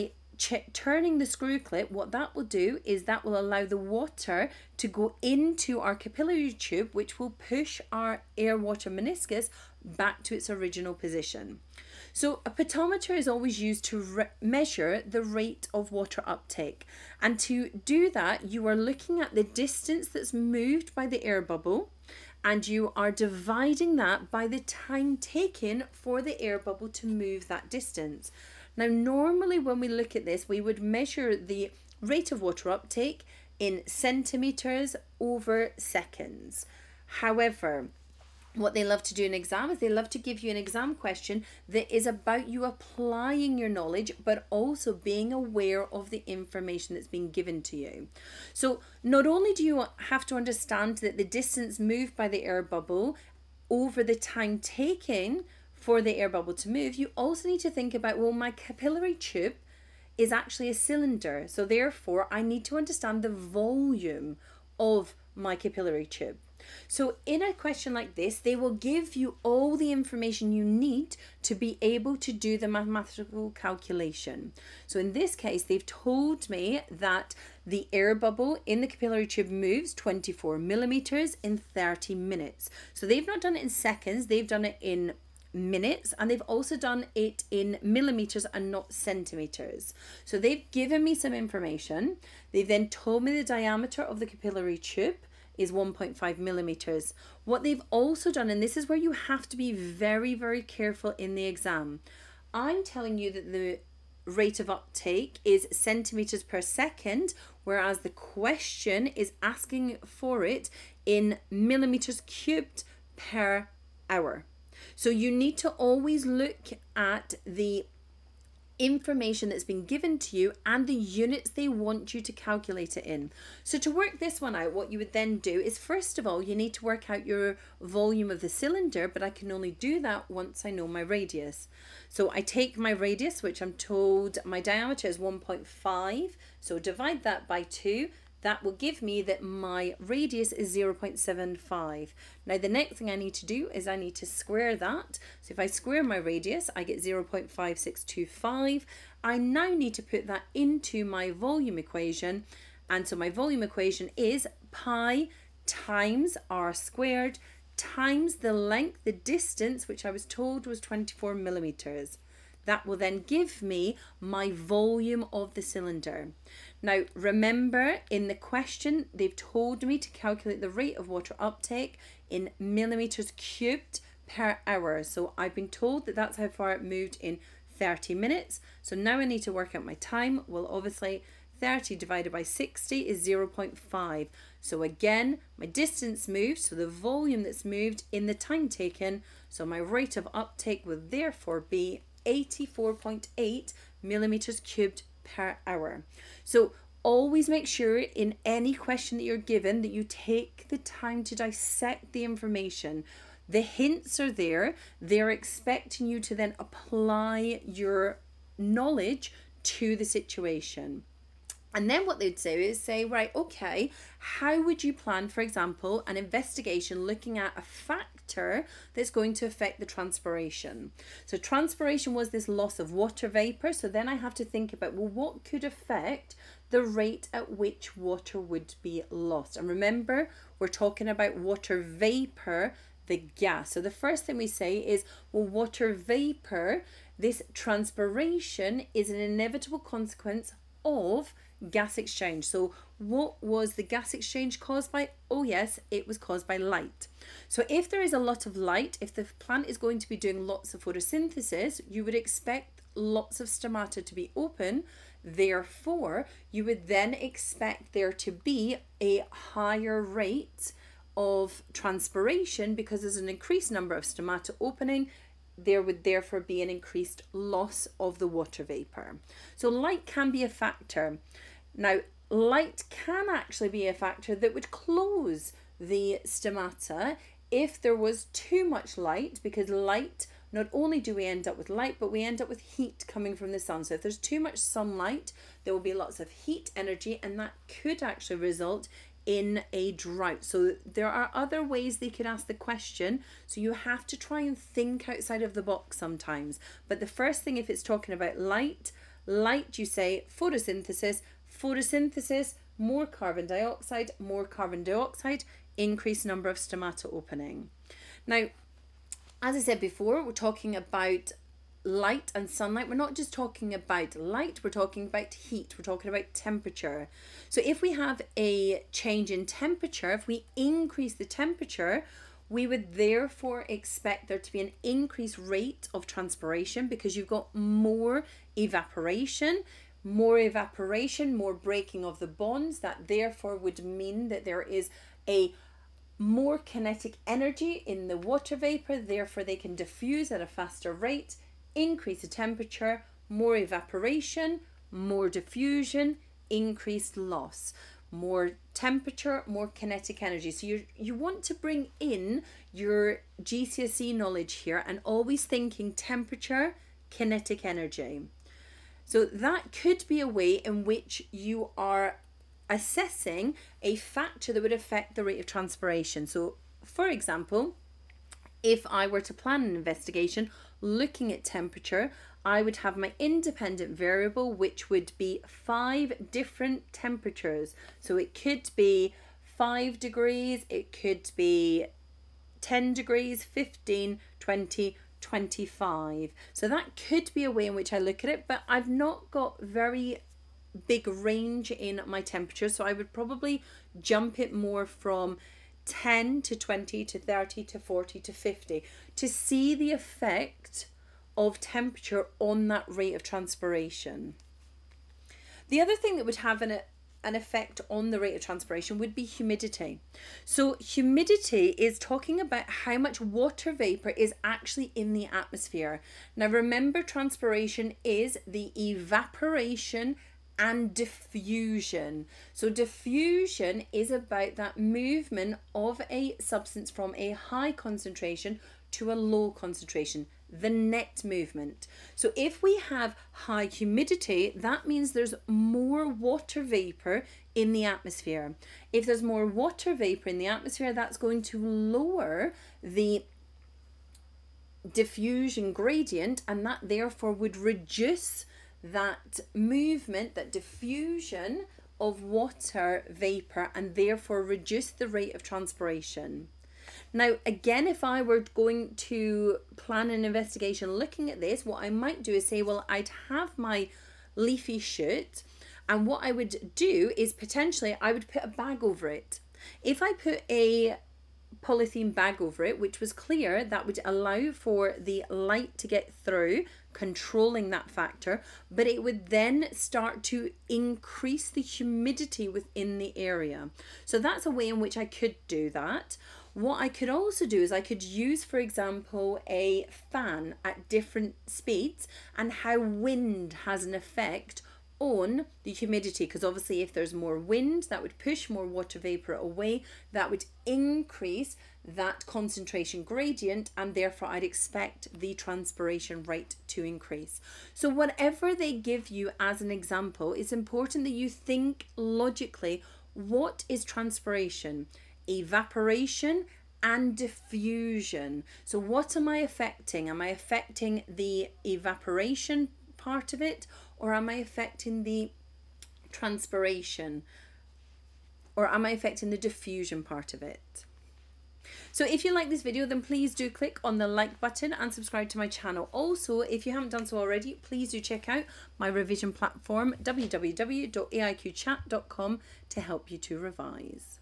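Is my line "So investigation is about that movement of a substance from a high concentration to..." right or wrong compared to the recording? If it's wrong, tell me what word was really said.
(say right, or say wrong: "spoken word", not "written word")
wrong: "diffusion", not "investigation".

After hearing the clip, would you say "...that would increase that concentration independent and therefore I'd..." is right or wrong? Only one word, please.
wrong.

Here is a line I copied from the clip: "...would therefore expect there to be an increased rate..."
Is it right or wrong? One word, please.
right.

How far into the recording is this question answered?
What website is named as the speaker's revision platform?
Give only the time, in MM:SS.
09:00.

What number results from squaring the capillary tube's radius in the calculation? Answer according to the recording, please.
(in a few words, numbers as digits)
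0.5625.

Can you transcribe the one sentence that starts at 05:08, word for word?
Now, as I said before, we're talking about light and sunlight.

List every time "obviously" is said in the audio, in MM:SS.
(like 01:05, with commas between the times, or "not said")
03:00, 08:16.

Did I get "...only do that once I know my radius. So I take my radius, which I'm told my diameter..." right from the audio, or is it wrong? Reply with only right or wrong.
right.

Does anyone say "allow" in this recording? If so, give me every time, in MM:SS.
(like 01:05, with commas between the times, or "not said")
00:03, 07:54.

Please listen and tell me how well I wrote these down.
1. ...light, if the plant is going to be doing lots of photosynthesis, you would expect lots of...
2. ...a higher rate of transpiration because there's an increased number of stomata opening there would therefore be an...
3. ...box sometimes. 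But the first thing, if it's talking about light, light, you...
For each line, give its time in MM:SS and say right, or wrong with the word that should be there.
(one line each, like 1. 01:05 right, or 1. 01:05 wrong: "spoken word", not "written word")
1. 04:08 right
2. 04:19 right
3. 04:55 right.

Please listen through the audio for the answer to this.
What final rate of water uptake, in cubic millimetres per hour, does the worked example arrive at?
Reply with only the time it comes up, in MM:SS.
03:12.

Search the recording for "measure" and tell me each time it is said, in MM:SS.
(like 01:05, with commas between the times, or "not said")
00:14, 00:30.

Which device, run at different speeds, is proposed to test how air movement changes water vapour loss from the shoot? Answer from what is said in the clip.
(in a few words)
a fan.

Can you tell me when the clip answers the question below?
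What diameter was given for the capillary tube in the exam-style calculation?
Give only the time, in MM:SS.
01:35.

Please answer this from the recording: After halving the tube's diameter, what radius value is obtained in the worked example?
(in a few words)
0.75.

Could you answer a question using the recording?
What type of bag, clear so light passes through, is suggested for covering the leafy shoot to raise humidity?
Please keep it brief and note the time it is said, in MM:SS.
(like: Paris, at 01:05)
polythene bag, at 07:51.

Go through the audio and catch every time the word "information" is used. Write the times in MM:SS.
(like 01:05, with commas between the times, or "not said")
00:46, 01:09, 01:31, 01:58, 03:22.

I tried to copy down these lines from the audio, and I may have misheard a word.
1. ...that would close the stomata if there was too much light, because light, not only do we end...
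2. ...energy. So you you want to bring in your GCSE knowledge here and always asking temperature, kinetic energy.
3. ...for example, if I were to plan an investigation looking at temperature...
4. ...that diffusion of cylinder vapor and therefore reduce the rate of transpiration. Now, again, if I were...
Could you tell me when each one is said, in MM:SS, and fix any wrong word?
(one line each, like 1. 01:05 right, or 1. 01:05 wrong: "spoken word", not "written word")
1. 04:34 right
2. 05:50 wrong: "thinking", not "asking"
3. 06:06 right
4. 07:30 wrong: "water", not "cylinder".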